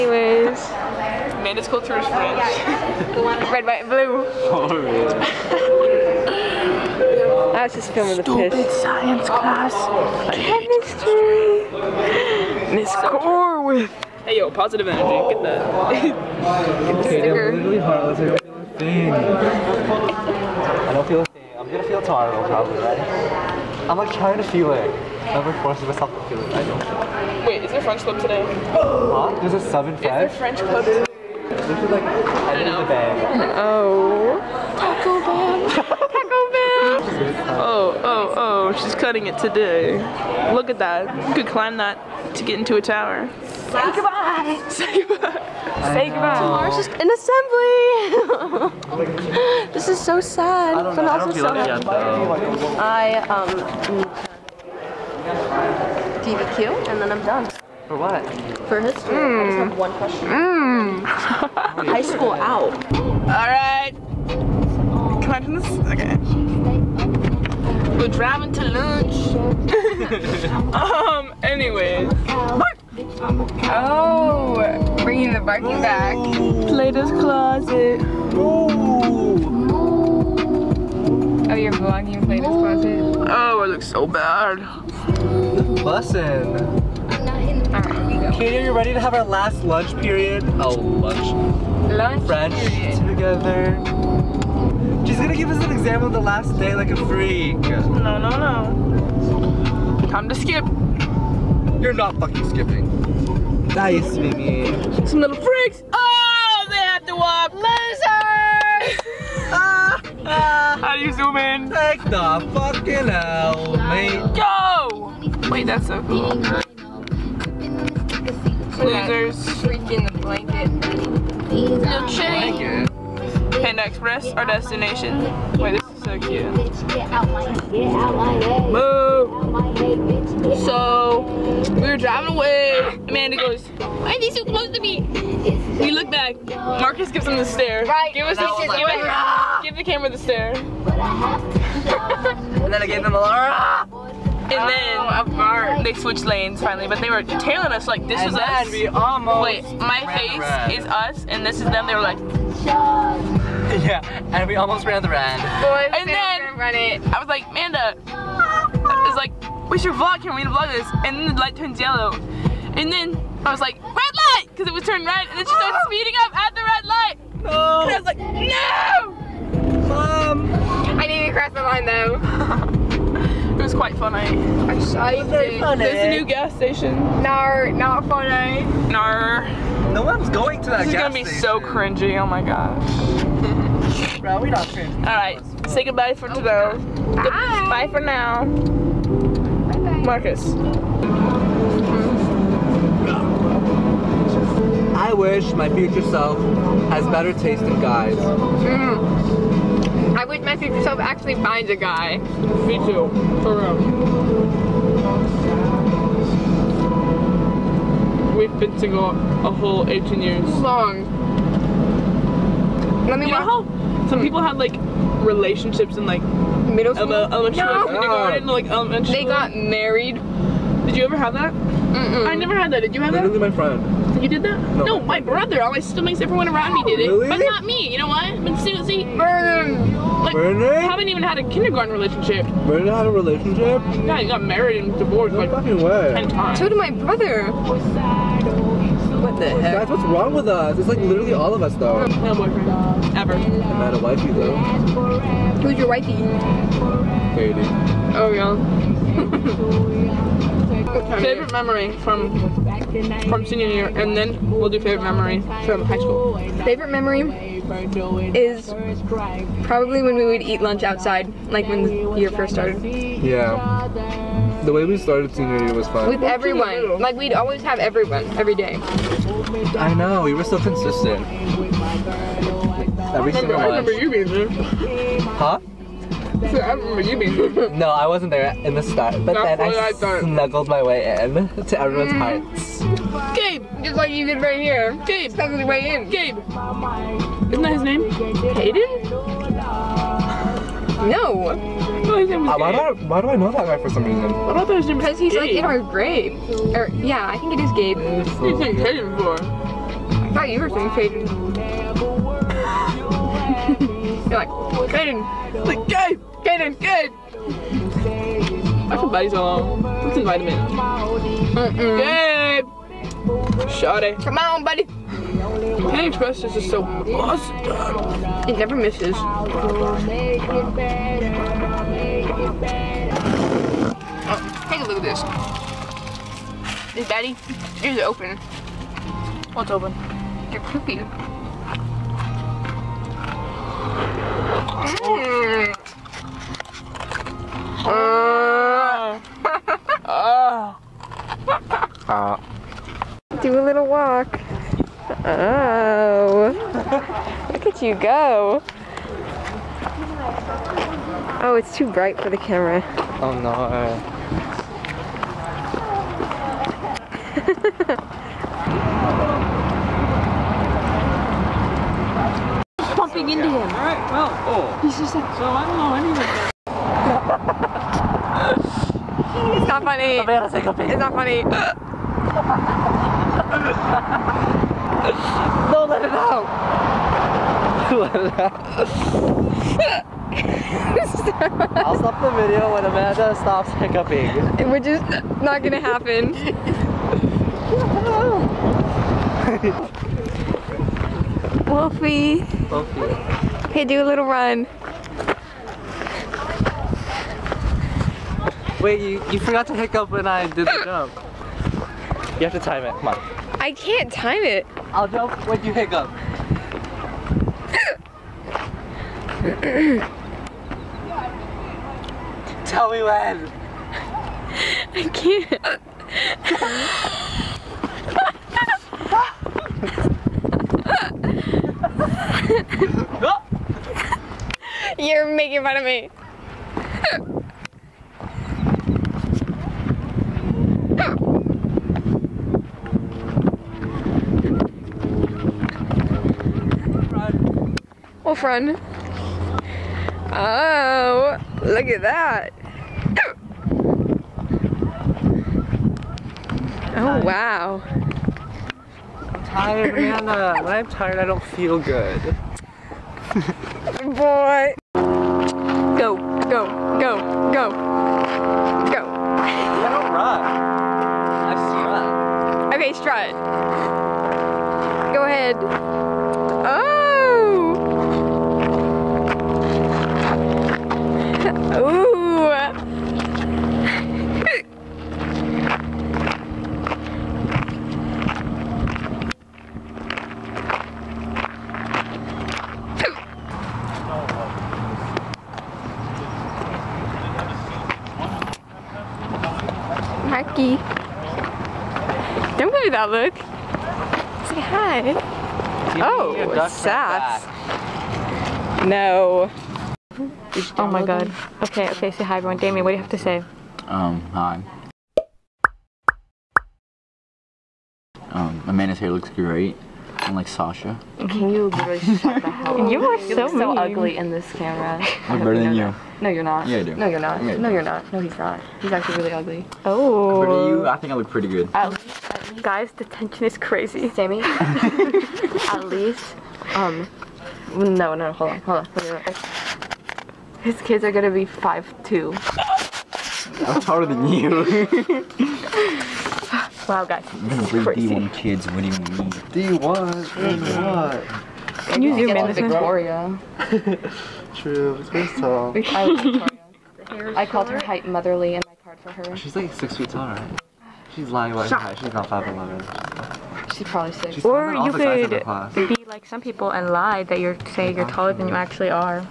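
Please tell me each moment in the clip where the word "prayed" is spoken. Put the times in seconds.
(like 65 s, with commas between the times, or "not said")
not said.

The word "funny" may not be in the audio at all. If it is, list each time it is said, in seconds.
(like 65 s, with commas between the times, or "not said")
173 s, 178 s, 369 s, 374 s.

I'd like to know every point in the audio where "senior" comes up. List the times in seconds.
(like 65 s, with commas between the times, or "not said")
253 s, 265 s.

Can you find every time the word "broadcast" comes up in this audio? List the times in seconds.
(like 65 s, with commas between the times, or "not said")
not said.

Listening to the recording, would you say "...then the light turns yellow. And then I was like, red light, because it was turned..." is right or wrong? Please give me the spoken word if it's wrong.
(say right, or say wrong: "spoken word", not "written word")
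right.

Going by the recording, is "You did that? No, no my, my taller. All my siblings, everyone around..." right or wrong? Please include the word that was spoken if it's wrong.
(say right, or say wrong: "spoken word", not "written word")
wrong: "brother", not "taller".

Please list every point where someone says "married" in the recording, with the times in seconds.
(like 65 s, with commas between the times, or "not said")
219 s, 234 s.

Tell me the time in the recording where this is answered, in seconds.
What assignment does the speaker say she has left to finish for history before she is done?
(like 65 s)
56 s.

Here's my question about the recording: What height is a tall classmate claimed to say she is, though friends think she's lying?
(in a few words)
5'11.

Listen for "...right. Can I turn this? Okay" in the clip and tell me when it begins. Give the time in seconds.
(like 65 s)
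63 s.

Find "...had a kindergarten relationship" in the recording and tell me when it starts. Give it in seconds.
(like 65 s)
231 s.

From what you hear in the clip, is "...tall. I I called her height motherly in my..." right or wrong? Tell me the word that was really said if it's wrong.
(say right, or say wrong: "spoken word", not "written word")
right.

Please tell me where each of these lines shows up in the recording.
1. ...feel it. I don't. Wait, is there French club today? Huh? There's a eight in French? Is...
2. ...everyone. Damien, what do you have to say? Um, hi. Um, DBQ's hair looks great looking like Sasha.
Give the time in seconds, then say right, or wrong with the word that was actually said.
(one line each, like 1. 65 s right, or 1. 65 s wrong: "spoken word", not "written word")
1. 26 s wrong: "seven", not "eight"
2. 502 s wrong: "Amanda", not "DBQ".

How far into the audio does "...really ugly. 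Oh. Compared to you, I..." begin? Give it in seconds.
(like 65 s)
519 s.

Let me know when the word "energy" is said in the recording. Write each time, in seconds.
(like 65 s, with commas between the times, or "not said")
14 s.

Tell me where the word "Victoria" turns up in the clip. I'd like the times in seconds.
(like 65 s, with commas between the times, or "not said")
542 s.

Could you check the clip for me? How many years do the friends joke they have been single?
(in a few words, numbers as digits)
18.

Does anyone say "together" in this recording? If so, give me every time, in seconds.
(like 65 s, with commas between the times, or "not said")
93 s.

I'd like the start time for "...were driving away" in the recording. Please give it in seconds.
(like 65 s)
131 s.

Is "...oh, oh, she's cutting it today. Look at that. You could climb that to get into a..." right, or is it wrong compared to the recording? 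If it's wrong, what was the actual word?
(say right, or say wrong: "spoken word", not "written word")
right.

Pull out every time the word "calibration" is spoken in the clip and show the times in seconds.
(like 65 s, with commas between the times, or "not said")
not said.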